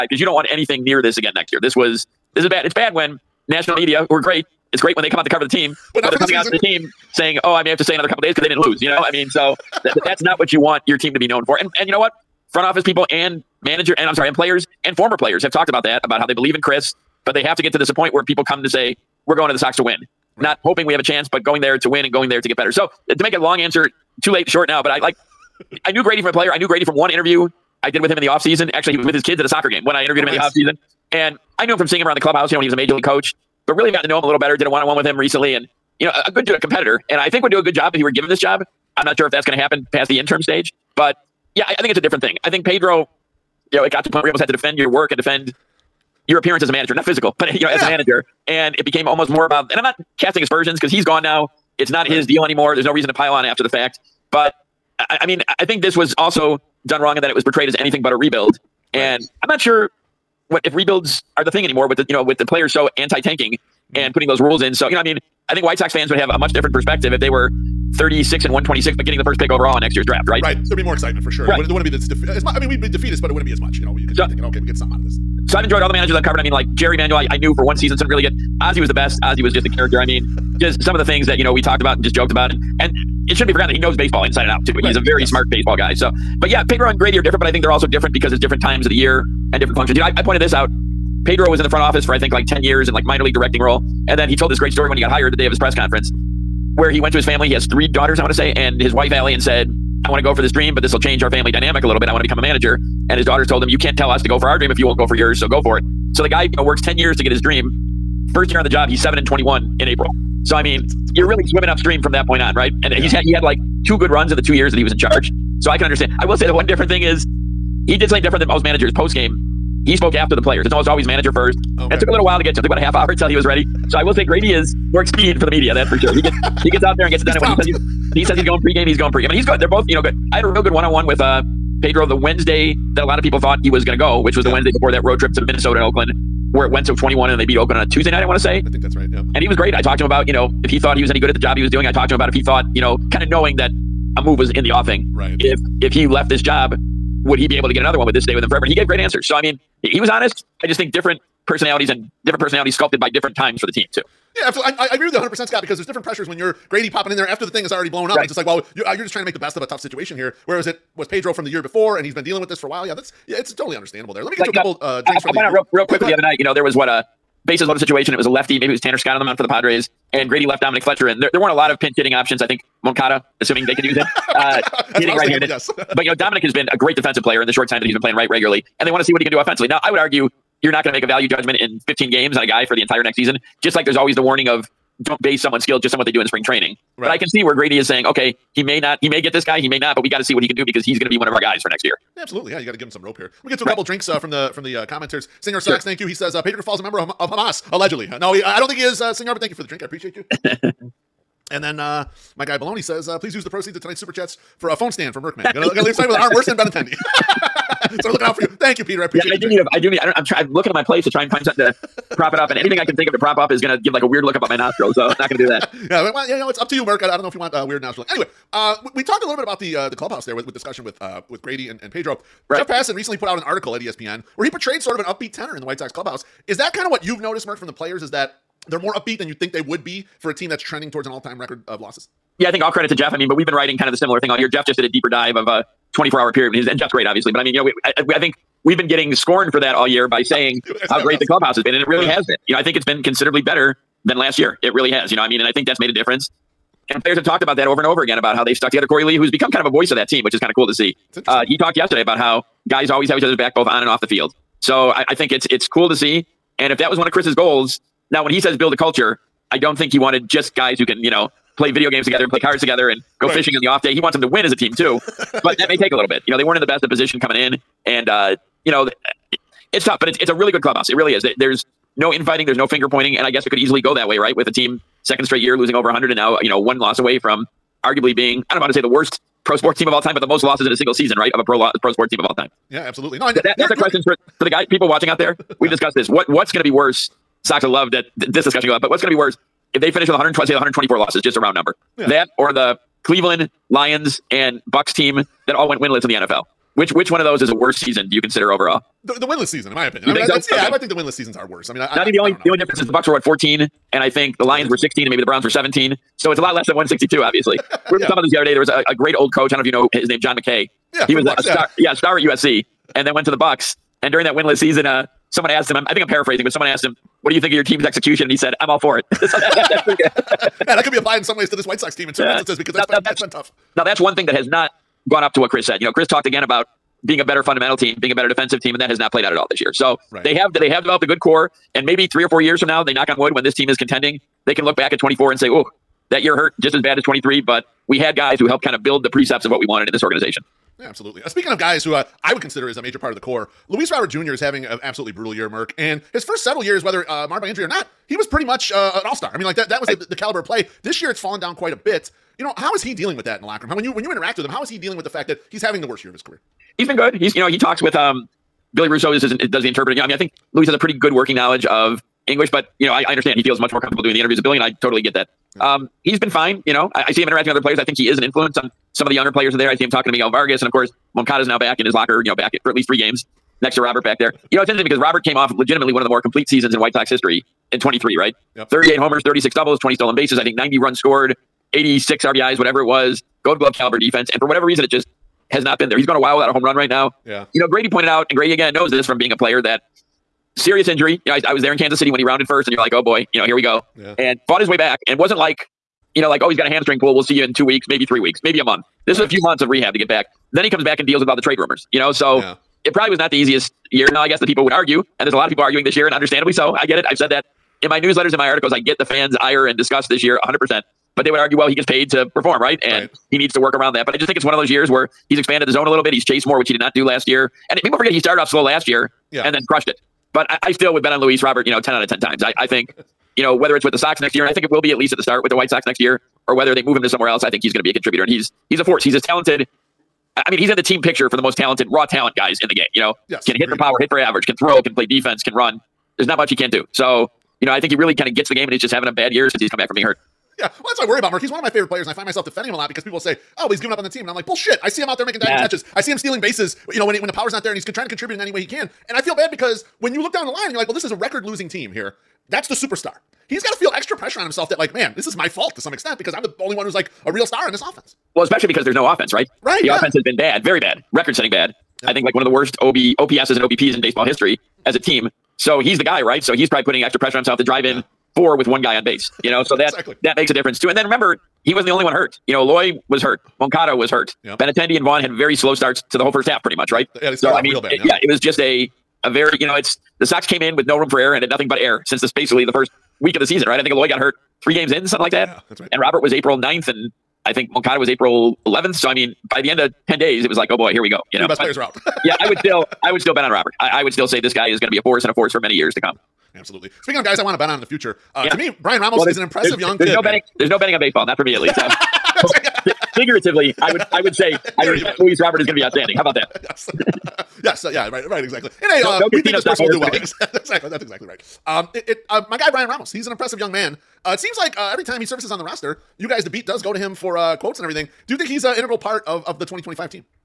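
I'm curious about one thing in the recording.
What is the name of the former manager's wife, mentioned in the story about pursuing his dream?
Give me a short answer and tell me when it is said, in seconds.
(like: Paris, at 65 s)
Allie, at 99 s.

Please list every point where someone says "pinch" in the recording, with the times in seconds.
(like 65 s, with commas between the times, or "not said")
171 s.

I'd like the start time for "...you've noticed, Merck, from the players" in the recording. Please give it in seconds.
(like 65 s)
227 s.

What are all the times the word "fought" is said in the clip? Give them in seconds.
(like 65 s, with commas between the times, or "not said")
394 s.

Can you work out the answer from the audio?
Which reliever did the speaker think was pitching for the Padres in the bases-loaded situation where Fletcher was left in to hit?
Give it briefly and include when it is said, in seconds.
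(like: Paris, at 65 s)
Tanner Scott, at 168 s.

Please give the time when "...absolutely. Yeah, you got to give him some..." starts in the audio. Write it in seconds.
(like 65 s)
192 s.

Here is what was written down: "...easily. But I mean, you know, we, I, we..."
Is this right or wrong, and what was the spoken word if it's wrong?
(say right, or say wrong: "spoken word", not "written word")
wrong: "obviously", not "easily".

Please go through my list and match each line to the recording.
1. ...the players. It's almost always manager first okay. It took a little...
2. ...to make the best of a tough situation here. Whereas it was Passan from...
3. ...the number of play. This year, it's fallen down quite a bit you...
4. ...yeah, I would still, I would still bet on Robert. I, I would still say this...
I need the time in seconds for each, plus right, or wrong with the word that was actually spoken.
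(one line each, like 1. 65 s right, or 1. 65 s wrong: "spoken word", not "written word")
1. 120 s right
2. 159 s wrong: "Pedro", not "Passan"
3. 350 s wrong: "caliber", not "number"
4. 492 s right.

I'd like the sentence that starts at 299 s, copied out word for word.
The, the winless season, in my opinion.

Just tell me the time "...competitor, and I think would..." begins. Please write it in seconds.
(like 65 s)
36 s.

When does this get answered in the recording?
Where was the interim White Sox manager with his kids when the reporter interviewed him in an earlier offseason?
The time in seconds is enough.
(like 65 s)
29 s.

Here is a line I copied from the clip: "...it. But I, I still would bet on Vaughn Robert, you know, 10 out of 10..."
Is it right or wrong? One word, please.
wrong.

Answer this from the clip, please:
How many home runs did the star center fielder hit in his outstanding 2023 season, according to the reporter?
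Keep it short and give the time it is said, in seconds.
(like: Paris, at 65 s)
38, at 378 s.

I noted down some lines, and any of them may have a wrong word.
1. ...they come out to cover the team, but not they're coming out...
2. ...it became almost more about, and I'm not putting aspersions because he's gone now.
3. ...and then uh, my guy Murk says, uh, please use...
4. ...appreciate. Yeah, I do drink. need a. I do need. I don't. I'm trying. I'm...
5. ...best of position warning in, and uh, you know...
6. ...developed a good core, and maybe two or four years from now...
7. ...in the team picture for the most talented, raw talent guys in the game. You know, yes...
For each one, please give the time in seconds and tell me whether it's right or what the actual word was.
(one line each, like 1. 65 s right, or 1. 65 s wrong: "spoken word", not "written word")
1. 5 s right
2. 48 s wrong: "casting", not "putting"
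3. 201 s wrong: "Baloney", not "Murk"
4. 209 s right
5. 266 s wrong: "coming", not "warning"
6. 330 s wrong: "three", not "two"
7. 430 s right.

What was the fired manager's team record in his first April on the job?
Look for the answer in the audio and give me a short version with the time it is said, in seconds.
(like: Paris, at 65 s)
7 and 21, at 109 s.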